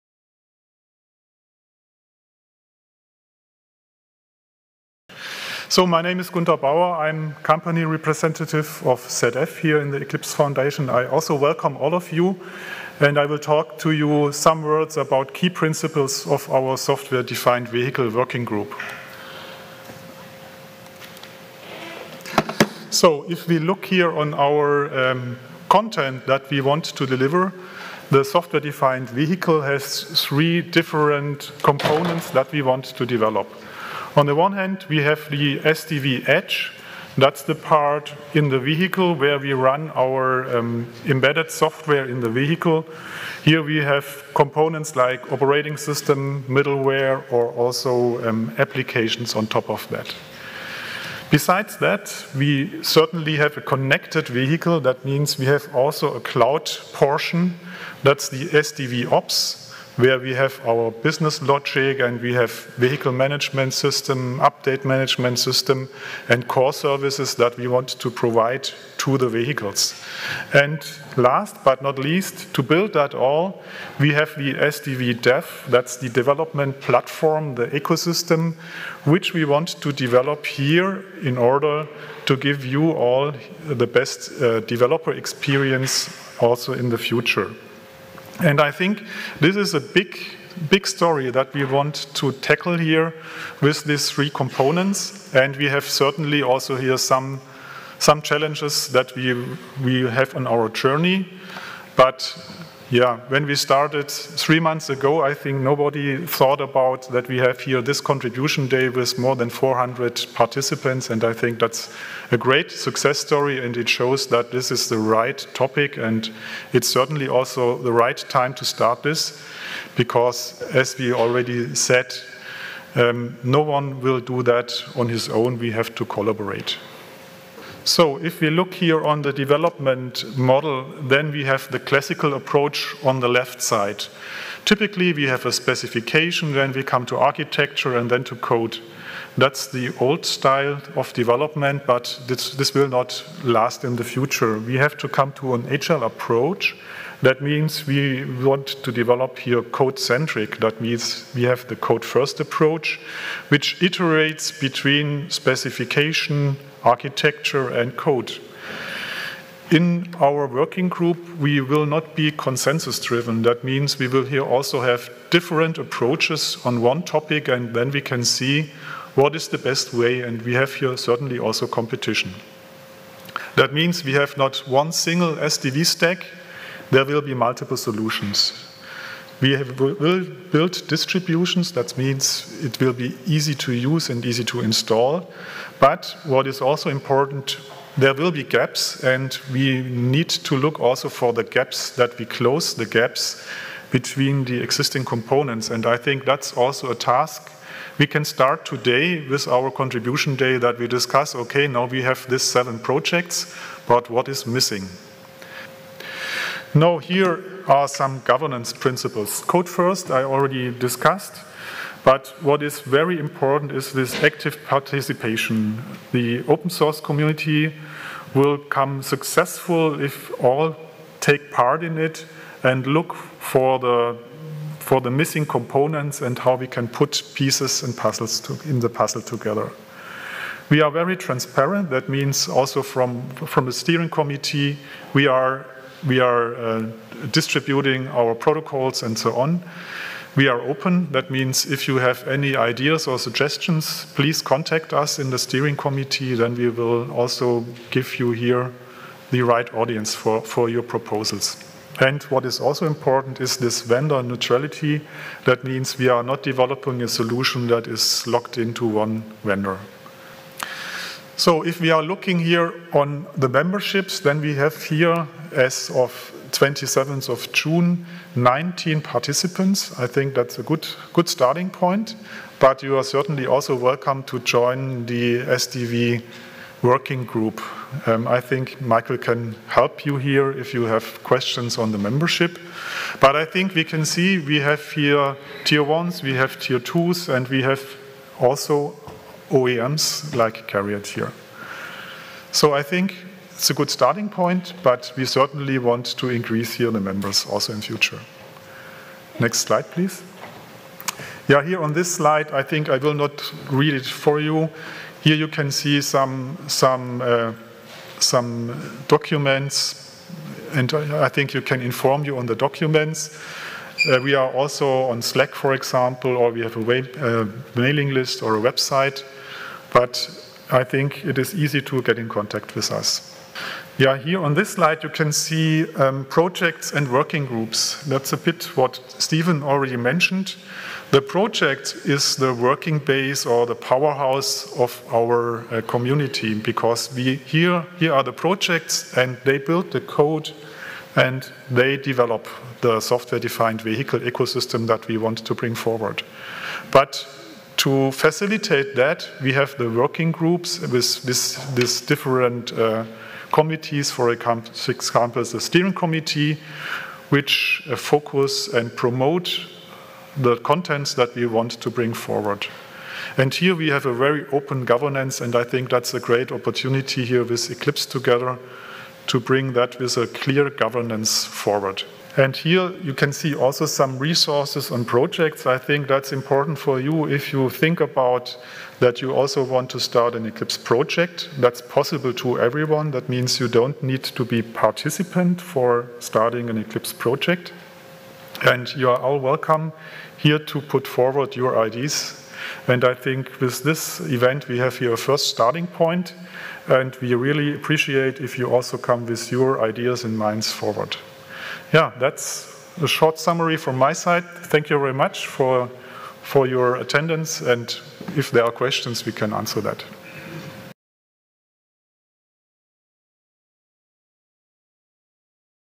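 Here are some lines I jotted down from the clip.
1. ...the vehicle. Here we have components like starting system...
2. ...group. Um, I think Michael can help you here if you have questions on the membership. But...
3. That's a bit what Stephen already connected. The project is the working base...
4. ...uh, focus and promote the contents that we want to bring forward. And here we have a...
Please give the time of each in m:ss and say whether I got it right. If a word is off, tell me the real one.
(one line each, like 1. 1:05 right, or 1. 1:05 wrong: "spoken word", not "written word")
1. 0:42 wrong: "operating", not "starting"
2. 4:37 right
3. 5:28 wrong: "mentioned", not "connected"
4. 5:57 right.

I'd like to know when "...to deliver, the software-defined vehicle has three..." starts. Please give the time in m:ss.
0:26.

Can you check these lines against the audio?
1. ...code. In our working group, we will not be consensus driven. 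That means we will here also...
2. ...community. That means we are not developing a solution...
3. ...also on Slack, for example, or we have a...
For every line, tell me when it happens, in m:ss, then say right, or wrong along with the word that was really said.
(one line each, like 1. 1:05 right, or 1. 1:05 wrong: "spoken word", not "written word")
1. 2:37 right
2. 4:14 wrong: "neutrality", not "community"
3. 5:14 right.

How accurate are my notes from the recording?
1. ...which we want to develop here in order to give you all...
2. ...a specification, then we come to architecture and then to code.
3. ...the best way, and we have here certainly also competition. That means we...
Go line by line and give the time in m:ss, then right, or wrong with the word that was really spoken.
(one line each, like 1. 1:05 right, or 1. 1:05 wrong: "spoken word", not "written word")
1. 1:19 right
2. 2:15 right
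3. 2:49 right.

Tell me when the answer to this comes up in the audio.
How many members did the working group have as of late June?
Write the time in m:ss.
4:28.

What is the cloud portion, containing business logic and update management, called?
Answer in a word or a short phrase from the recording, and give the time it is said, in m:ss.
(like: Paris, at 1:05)
SDV ops, at 0:58.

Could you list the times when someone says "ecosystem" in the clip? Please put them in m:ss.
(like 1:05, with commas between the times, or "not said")
1:17, 5:44.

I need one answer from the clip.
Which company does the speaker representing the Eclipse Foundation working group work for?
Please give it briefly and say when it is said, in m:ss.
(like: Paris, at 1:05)
ZF, at 0:09.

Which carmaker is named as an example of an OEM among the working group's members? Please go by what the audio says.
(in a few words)
CARIAD.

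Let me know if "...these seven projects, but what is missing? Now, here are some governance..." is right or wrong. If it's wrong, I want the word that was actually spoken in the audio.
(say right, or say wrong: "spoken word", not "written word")
right.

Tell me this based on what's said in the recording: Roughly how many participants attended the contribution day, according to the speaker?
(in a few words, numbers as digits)
more than 400.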